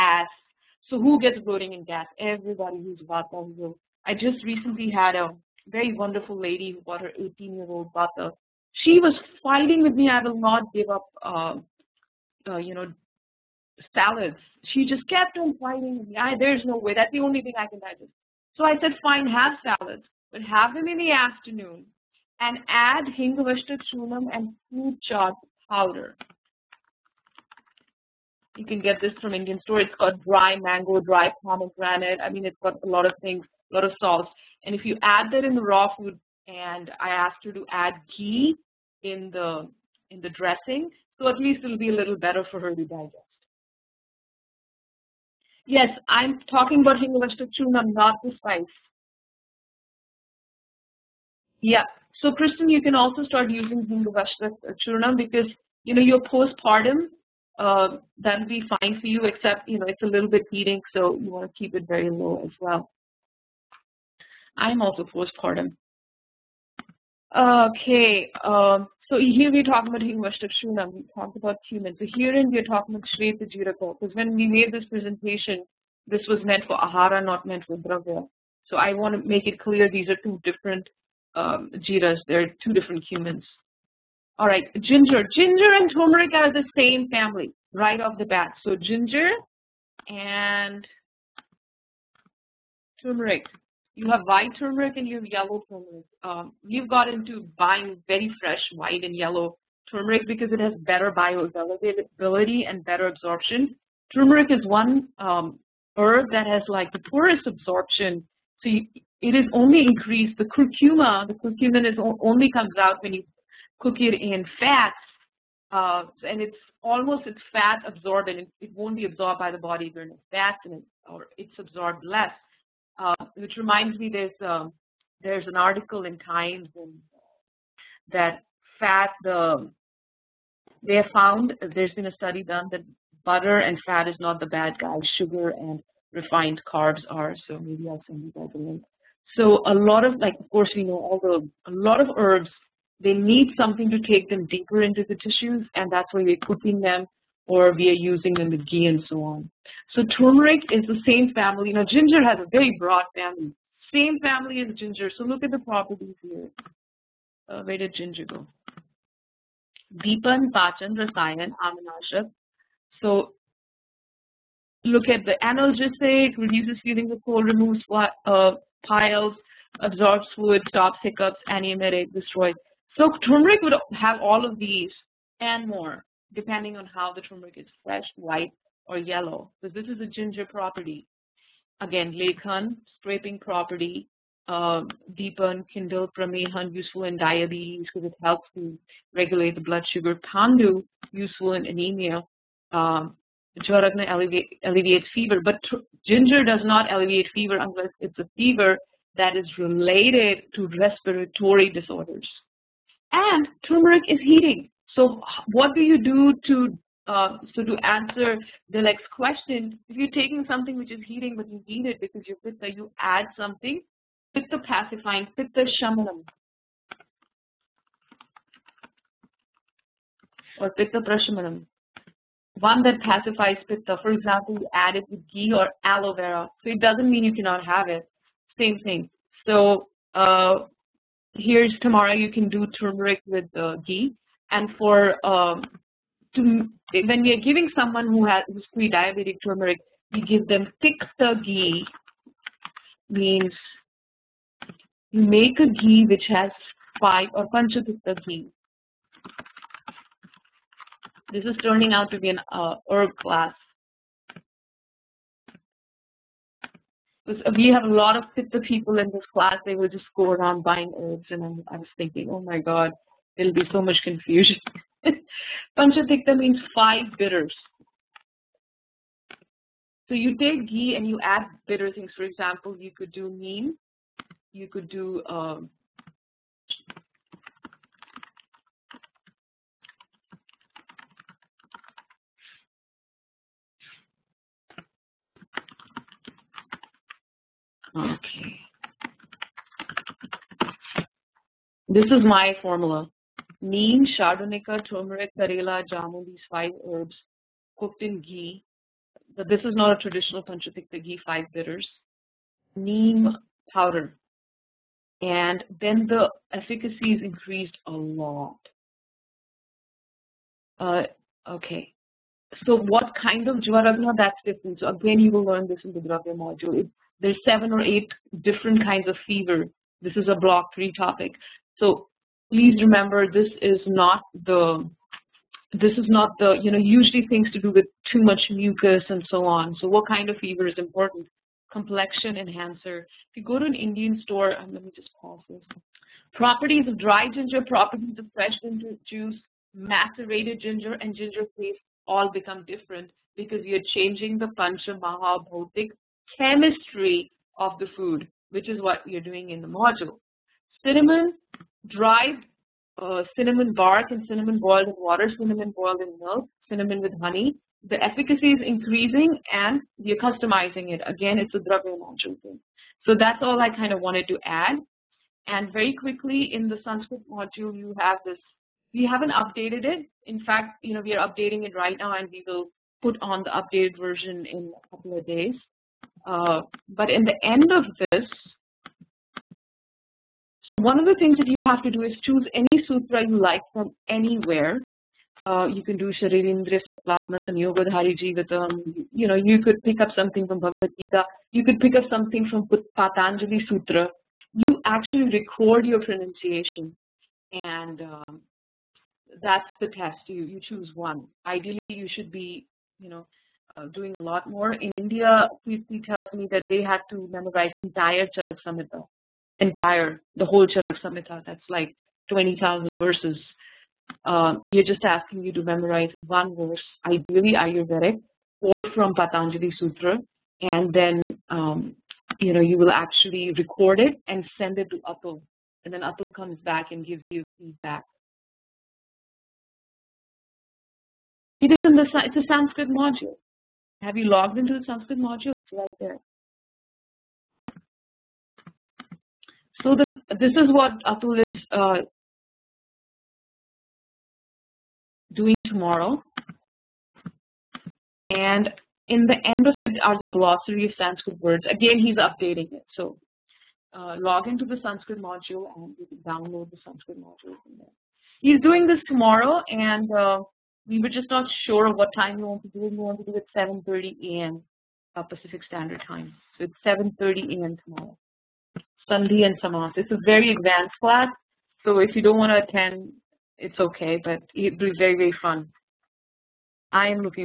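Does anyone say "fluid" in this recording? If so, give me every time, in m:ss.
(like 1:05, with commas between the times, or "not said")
2:50.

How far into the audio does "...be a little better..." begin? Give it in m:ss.
0:41.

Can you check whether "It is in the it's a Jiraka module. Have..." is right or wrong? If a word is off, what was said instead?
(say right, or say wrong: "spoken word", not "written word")
wrong: "Sanskrit", not "Jiraka".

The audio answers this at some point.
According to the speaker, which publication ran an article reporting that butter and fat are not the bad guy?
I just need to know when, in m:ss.
2:06.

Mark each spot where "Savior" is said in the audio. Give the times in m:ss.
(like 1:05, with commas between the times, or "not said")
not said.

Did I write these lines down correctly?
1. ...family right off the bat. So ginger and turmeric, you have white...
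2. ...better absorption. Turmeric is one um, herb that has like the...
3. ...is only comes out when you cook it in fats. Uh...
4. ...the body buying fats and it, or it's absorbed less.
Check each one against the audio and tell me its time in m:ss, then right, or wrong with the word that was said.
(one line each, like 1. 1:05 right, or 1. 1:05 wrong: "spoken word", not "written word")
1. 1:27 right
2. 1:42 right
3. 1:51 right
4. 1:59 wrong: "during", not "buying".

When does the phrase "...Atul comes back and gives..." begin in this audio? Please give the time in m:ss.
7:06.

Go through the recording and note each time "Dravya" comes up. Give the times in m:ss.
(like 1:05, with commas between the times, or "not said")
1:17, 5:15, 6:01.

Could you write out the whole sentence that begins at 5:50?
Cinnamon, dried uh, cinnamon bark and cinnamon boiled in water, cinnamon boiled in milk, cinnamon with honey.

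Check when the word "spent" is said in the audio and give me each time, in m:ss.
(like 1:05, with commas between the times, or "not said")
not said.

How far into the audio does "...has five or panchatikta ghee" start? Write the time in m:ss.
4:06.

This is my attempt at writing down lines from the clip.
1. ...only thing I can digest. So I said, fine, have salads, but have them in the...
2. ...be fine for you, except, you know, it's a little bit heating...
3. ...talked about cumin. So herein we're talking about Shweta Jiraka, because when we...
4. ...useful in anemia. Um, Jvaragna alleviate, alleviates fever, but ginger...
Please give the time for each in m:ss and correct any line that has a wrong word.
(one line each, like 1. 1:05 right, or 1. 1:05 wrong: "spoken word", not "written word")
1. 0:17 right
2. 0:58 right
3. 1:11 right
4. 3:11 right.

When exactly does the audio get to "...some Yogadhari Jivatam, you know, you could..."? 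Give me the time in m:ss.
6:27.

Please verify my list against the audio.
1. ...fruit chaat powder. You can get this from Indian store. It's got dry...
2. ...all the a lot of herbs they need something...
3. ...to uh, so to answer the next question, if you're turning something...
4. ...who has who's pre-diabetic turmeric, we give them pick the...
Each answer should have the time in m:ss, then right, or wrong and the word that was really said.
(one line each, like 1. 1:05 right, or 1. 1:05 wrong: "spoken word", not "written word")
1. 0:24 right
2. 2:20 right
3. 3:26 wrong: "taking", not "turning"
4. 3:58 right.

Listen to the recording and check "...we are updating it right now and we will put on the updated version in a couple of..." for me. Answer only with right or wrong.
right.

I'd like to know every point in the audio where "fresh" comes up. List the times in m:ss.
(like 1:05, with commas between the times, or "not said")
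1:38, 2:57, 5:38.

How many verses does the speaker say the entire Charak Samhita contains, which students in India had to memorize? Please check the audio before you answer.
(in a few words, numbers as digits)
20,000.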